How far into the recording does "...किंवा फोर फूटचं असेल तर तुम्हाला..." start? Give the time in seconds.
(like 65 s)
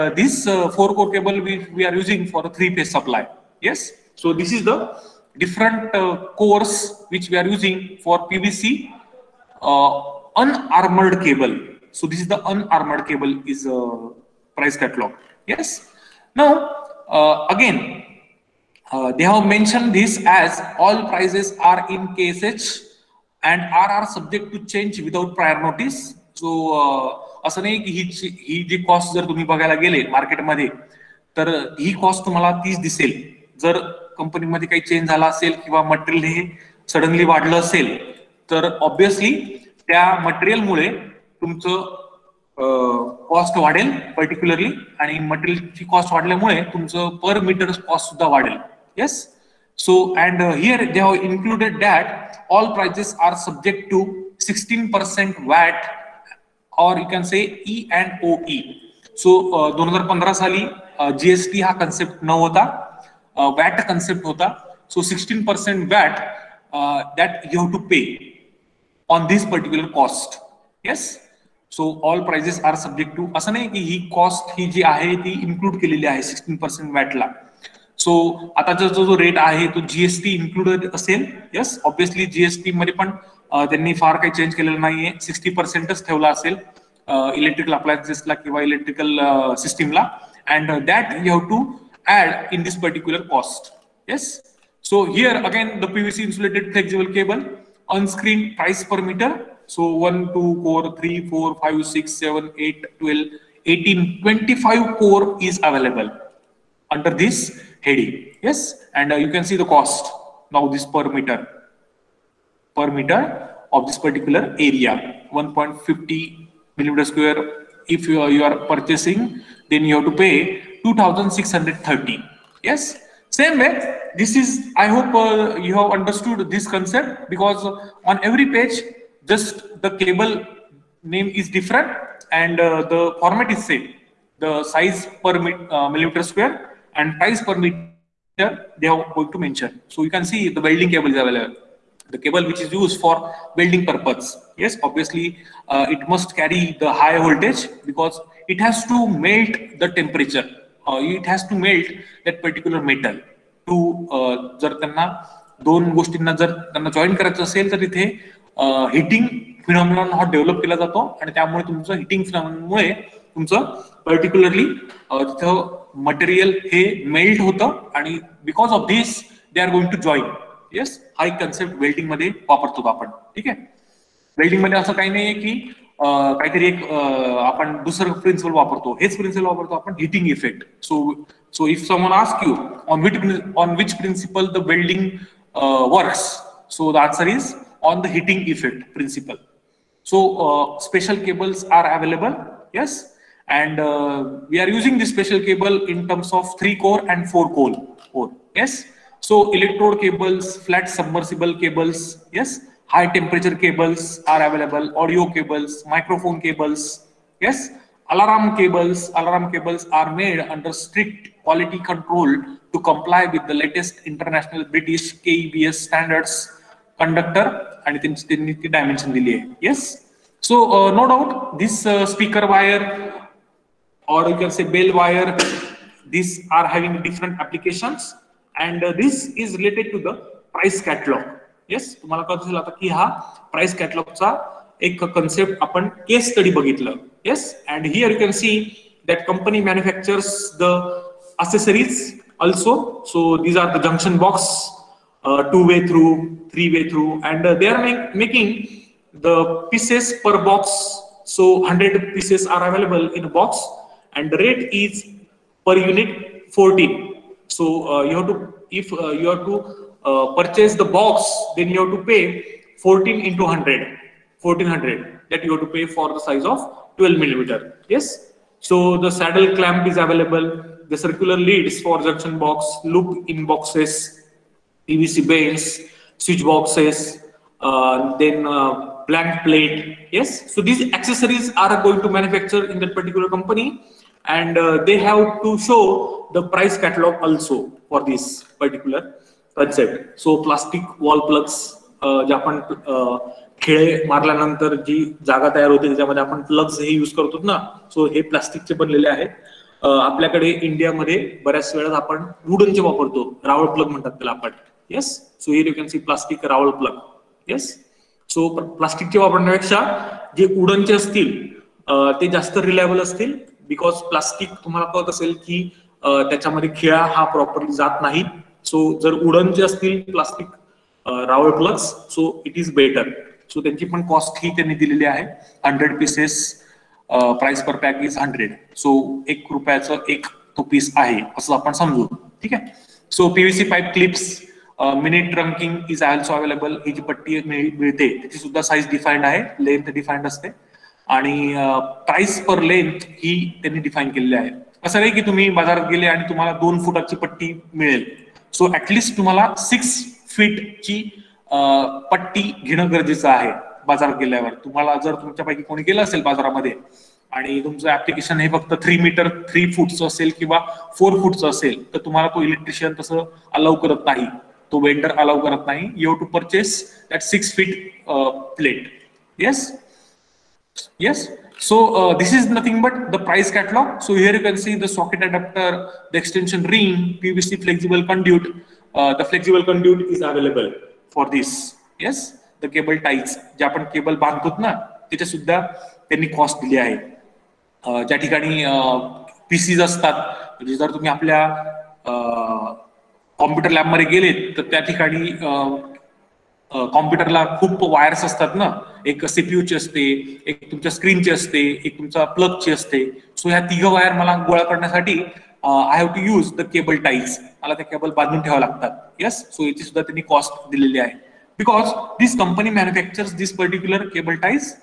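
360 s.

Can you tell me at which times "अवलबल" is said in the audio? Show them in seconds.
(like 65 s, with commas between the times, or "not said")
191 s, 336 s.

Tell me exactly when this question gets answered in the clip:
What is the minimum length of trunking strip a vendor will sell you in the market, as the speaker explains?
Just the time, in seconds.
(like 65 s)
349 s.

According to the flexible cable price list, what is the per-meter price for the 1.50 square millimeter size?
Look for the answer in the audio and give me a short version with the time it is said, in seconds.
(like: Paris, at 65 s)
2,630, at 120 s.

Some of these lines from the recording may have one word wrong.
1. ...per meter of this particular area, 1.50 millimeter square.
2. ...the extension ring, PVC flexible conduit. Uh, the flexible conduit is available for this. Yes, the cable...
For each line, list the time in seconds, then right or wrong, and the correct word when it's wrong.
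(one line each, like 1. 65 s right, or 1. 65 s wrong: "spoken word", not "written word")
1. 112 s right
2. 376 s right.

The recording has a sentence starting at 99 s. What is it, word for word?
So 1, 2, core, 3, 4, 5, 6, 7, 8, 12, 18, 25 core is available under this heading.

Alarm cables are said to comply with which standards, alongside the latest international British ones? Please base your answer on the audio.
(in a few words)
KEBS.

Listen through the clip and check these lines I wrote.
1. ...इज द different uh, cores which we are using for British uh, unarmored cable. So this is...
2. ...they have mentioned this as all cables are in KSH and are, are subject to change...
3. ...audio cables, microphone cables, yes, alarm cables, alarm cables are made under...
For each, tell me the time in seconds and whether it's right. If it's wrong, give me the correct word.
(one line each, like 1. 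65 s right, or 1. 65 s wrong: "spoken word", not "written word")
1. 4 s wrong: "PVC", not "British"
2. 19 s wrong: "prices", not "cables"
3. 205 s right.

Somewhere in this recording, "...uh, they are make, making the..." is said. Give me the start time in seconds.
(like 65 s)
247 s.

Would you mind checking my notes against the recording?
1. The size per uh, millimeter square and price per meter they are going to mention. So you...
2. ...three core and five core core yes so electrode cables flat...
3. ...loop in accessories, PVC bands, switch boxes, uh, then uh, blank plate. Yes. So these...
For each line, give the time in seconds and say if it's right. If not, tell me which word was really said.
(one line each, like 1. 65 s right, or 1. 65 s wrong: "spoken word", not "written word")
1. 134 s right
2. 196 s wrong: "four", not "five"
3. 272 s wrong: "boxes", not "accessories".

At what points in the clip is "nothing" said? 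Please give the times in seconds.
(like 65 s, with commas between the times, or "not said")
372 s.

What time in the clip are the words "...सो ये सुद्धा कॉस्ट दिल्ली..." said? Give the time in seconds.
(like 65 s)
409 s.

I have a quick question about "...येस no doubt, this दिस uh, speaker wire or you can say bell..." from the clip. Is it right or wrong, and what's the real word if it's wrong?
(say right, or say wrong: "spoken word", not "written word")
right.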